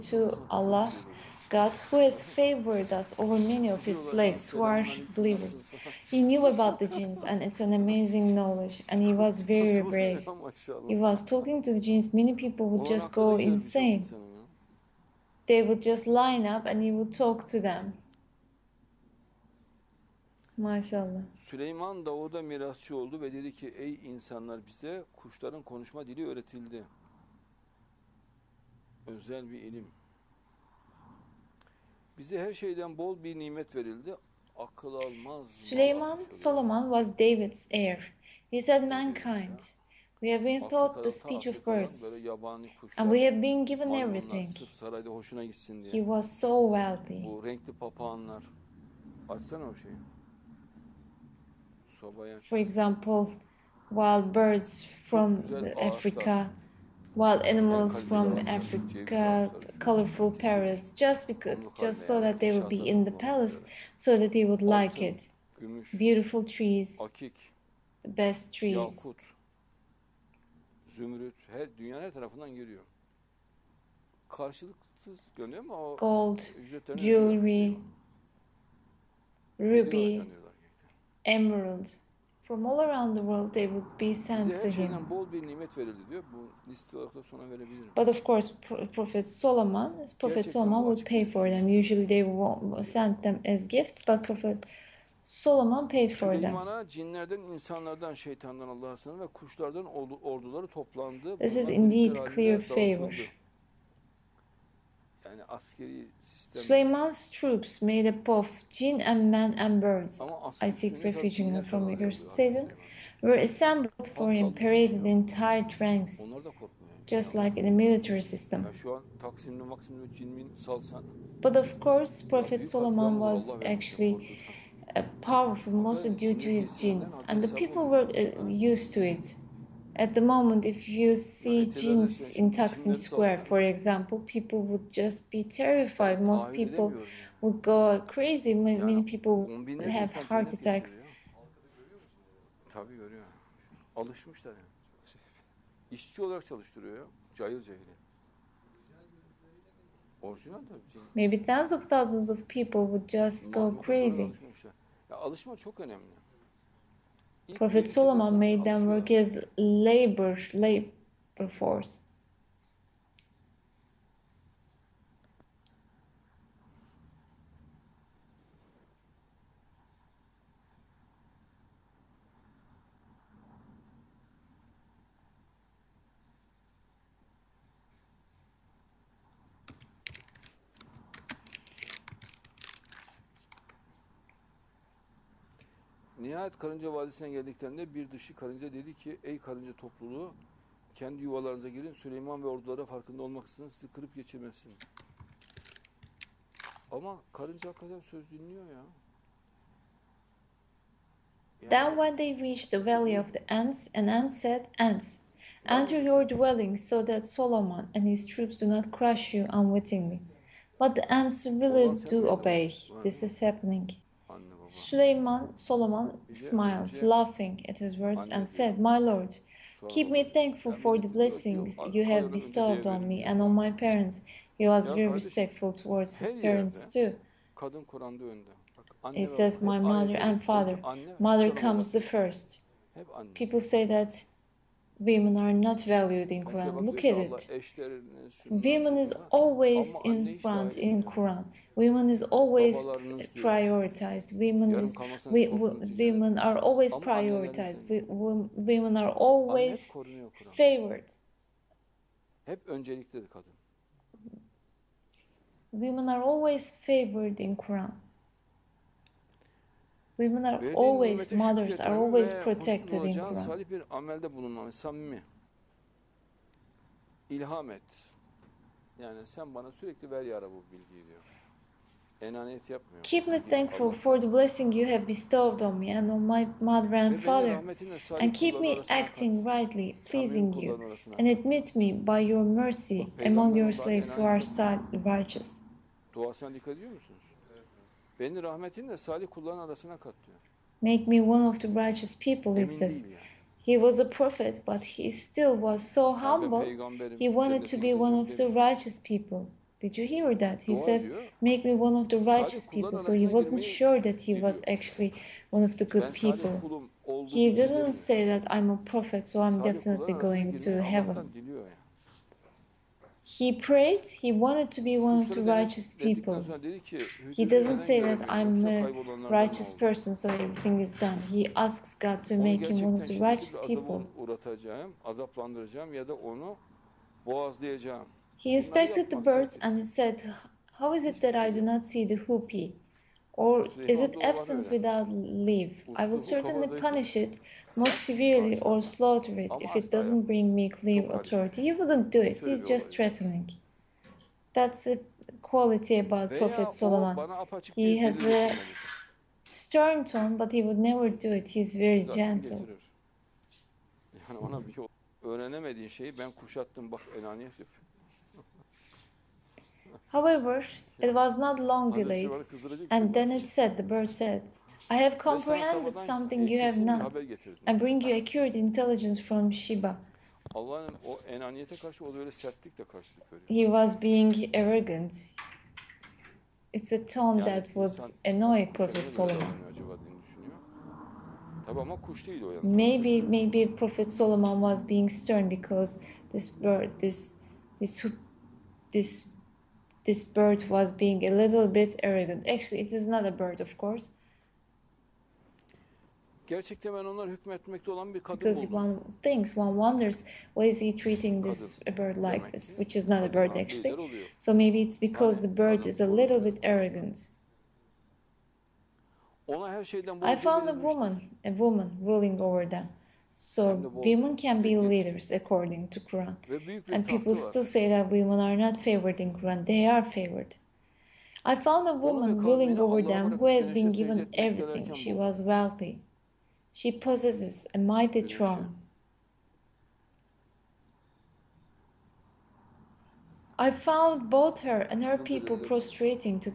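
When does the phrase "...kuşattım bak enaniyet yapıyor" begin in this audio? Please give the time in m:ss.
5:56.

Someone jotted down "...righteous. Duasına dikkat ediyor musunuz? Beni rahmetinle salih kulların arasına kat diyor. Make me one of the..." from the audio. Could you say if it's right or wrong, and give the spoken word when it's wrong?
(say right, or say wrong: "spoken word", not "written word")
right.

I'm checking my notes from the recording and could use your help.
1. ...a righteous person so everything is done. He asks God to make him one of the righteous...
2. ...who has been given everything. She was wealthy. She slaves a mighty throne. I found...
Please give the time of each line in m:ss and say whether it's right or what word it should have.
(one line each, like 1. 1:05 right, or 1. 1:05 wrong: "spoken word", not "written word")
1. 5:18 right
2. 7:03 wrong: "possesses", not "slaves".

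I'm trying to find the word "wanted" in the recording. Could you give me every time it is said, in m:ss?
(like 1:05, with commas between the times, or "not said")
4:57, 5:14.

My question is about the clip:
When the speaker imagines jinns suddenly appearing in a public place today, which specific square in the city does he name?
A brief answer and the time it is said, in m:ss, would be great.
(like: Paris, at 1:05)
Taksim Square, at 2:12.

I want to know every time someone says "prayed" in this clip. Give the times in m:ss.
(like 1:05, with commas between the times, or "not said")
5:13.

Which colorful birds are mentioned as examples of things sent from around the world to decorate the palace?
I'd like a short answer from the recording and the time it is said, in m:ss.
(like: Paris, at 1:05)
parrots, at 0:59.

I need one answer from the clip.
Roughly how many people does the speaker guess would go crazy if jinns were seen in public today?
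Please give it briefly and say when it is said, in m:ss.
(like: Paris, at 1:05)
tens of thousands, at 2:31.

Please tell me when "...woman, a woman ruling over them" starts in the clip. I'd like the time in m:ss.
6:50.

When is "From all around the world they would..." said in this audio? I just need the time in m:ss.
1:22.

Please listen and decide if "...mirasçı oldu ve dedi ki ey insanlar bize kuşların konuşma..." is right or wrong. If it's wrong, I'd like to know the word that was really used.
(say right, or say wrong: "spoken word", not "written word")
right.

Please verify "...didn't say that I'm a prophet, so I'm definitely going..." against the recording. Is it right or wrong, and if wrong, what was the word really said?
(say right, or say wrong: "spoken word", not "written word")
right.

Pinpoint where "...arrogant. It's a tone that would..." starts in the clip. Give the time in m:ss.
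6:14.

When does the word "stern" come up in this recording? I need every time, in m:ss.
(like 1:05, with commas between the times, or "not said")
5:49, 6:25.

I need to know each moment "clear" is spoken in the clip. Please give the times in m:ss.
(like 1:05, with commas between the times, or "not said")
1:42, 5:40.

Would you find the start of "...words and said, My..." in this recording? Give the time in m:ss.
3:37.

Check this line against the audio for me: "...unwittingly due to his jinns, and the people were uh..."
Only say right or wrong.
wrong.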